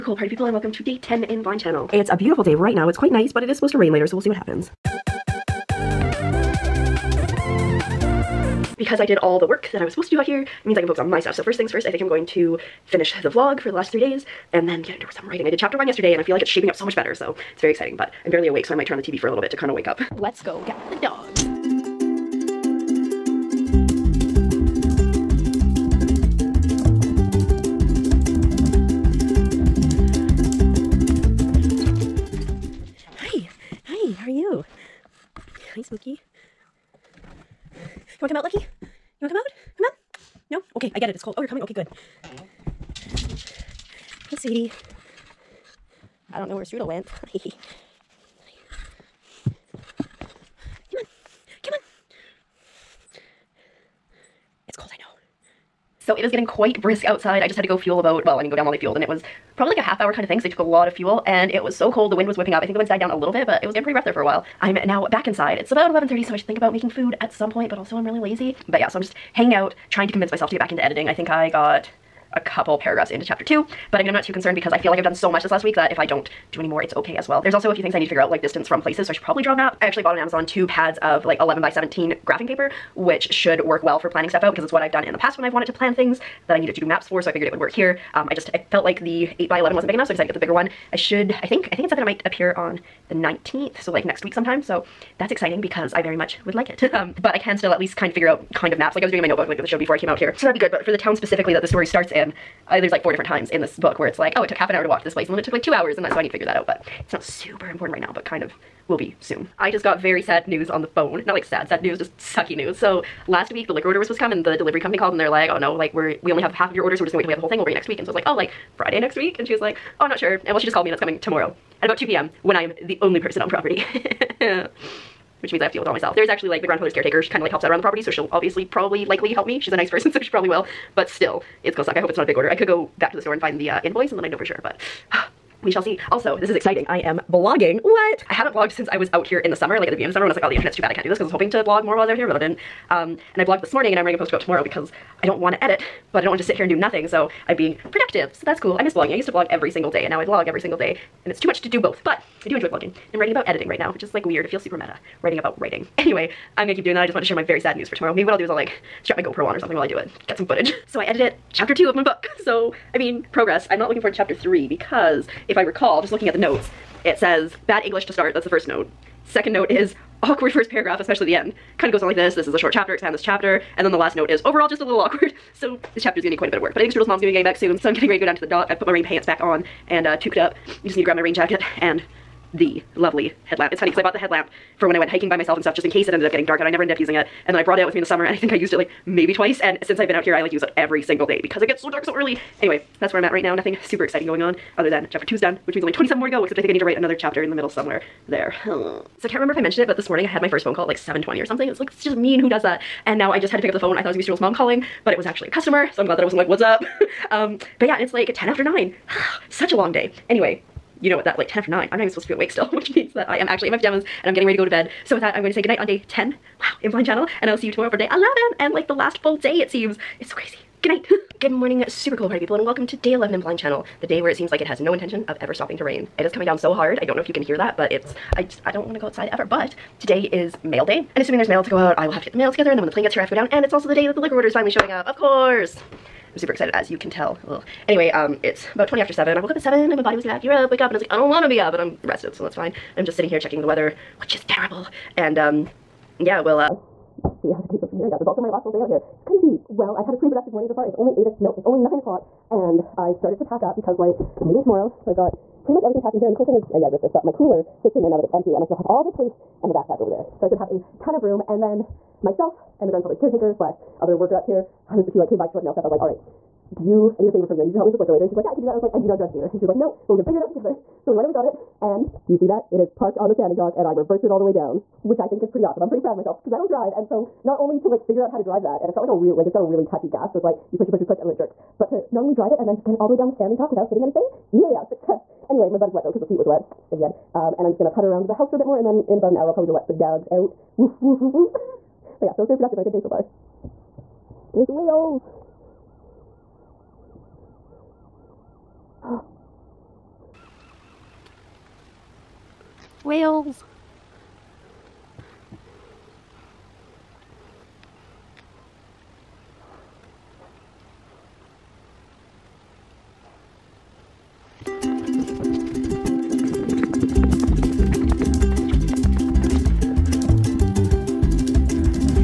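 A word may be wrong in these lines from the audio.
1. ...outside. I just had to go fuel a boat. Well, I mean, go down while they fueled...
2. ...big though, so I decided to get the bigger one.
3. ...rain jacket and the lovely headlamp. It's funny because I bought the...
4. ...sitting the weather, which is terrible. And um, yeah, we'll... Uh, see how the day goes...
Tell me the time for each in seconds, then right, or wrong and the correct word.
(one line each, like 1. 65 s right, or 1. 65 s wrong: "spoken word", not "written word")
1. 57 s right
2. 89 s wrong: "enough", not "though"
3. 181 s right
4. 243 s wrong: "checking", not "sitting".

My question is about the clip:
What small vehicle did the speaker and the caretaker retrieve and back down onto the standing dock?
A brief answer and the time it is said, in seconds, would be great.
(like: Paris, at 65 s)
The gator, at 269 s.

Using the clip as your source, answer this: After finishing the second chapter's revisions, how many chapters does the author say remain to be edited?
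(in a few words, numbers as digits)
27.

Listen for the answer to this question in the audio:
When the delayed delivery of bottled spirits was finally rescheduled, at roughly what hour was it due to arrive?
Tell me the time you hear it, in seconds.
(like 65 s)
121 s.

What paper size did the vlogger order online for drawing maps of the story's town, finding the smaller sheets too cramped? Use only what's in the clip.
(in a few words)
11 by 17.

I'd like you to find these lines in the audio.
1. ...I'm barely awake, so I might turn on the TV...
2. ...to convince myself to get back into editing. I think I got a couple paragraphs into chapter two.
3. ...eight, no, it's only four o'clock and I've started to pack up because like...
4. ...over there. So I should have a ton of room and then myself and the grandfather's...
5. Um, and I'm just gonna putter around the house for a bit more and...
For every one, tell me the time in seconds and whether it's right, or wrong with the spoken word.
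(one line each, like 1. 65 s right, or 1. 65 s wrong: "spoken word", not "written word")
1. 18 s right
2. 70 s right
3. 251 s wrong: "nine", not "four"
4. 259 s right
5. 287 s right.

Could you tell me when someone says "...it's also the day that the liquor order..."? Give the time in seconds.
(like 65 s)
233 s.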